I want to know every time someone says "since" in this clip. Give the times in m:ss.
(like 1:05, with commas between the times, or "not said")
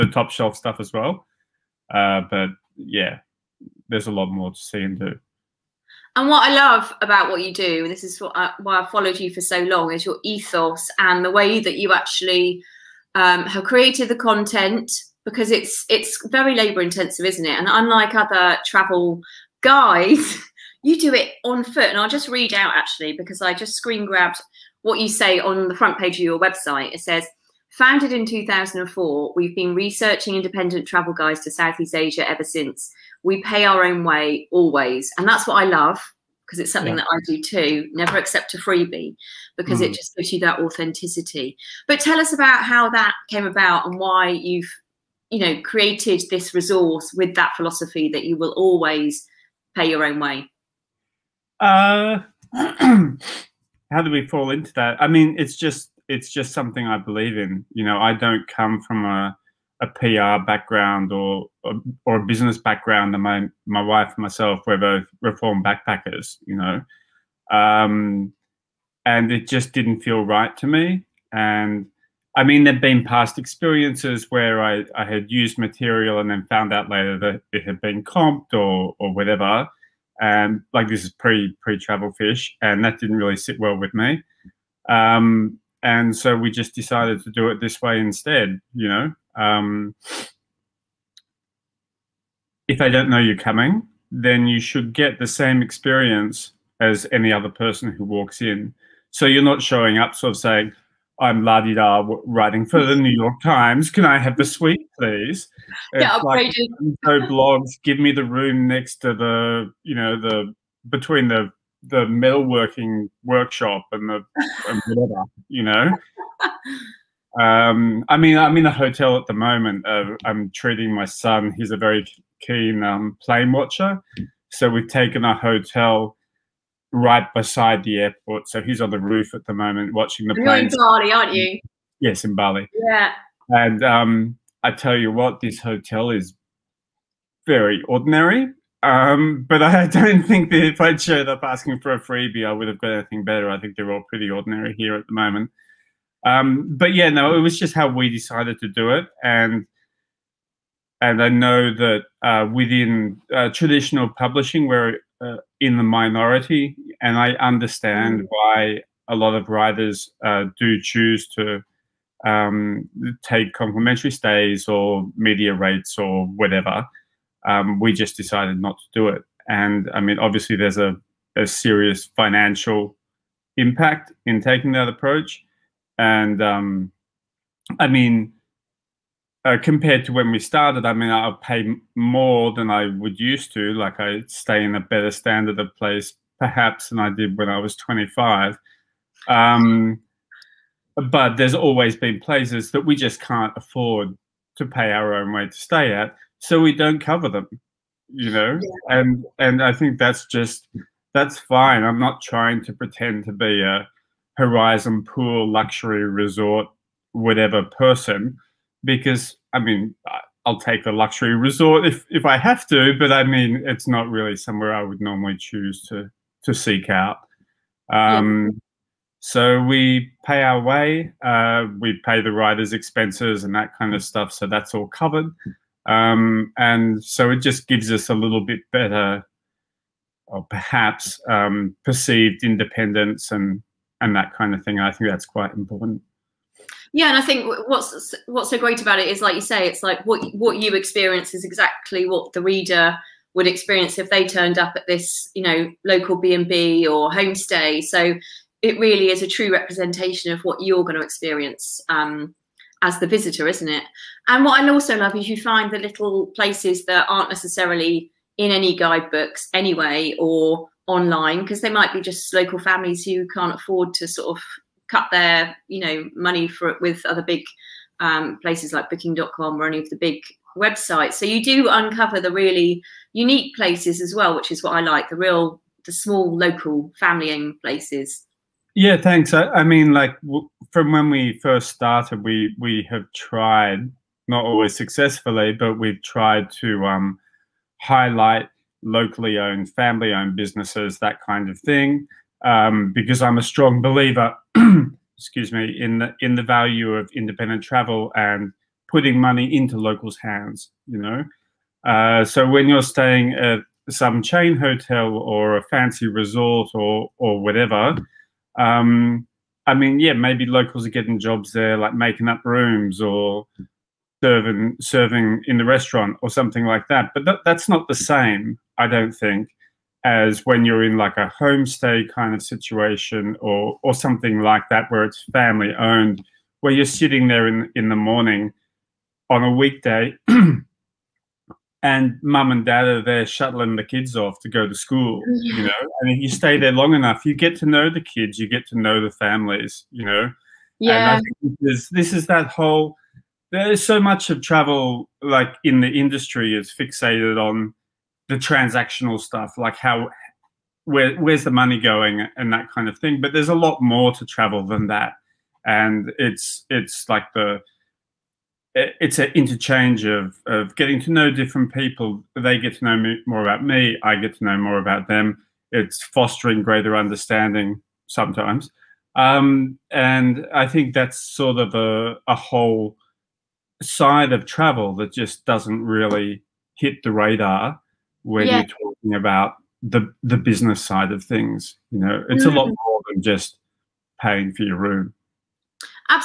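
0:32.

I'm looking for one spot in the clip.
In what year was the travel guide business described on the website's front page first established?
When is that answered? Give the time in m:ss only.
0:28.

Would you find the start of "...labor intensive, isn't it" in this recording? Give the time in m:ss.
0:16.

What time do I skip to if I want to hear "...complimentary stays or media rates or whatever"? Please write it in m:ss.
2:43.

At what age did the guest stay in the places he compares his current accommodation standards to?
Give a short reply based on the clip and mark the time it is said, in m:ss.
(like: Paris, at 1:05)
25, at 3:07.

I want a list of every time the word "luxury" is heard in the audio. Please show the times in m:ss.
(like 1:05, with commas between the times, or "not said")
3:25, 3:30.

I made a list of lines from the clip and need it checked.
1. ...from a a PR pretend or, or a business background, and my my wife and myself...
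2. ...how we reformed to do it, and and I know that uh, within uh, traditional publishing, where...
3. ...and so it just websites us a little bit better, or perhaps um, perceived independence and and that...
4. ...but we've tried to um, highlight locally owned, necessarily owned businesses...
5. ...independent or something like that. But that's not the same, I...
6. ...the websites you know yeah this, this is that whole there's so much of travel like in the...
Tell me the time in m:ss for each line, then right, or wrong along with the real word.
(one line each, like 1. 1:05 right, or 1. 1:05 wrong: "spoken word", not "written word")
1. 0:58 wrong: "background", not "pretend"
2. 2:27 wrong: "decided", not "reformed"
3. 3:46 wrong: "gives", not "websites"
4. 4:45 wrong: "family", not "necessarily"
5. 5:15 wrong: "restaurant", not "independent"
6. 5:39 wrong: "families", not "websites".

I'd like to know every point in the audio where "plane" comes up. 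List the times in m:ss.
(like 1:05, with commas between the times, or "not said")
2:03, 2:10.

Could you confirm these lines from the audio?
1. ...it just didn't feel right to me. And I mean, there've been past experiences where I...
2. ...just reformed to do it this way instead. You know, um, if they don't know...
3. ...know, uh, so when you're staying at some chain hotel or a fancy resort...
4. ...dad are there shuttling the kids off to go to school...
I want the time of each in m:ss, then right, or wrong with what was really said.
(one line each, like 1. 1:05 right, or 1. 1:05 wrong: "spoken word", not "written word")
1. 1:09 right
2. 1:26 wrong: "decided", not "reformed"
3. 5:00 right
4. 5:32 right.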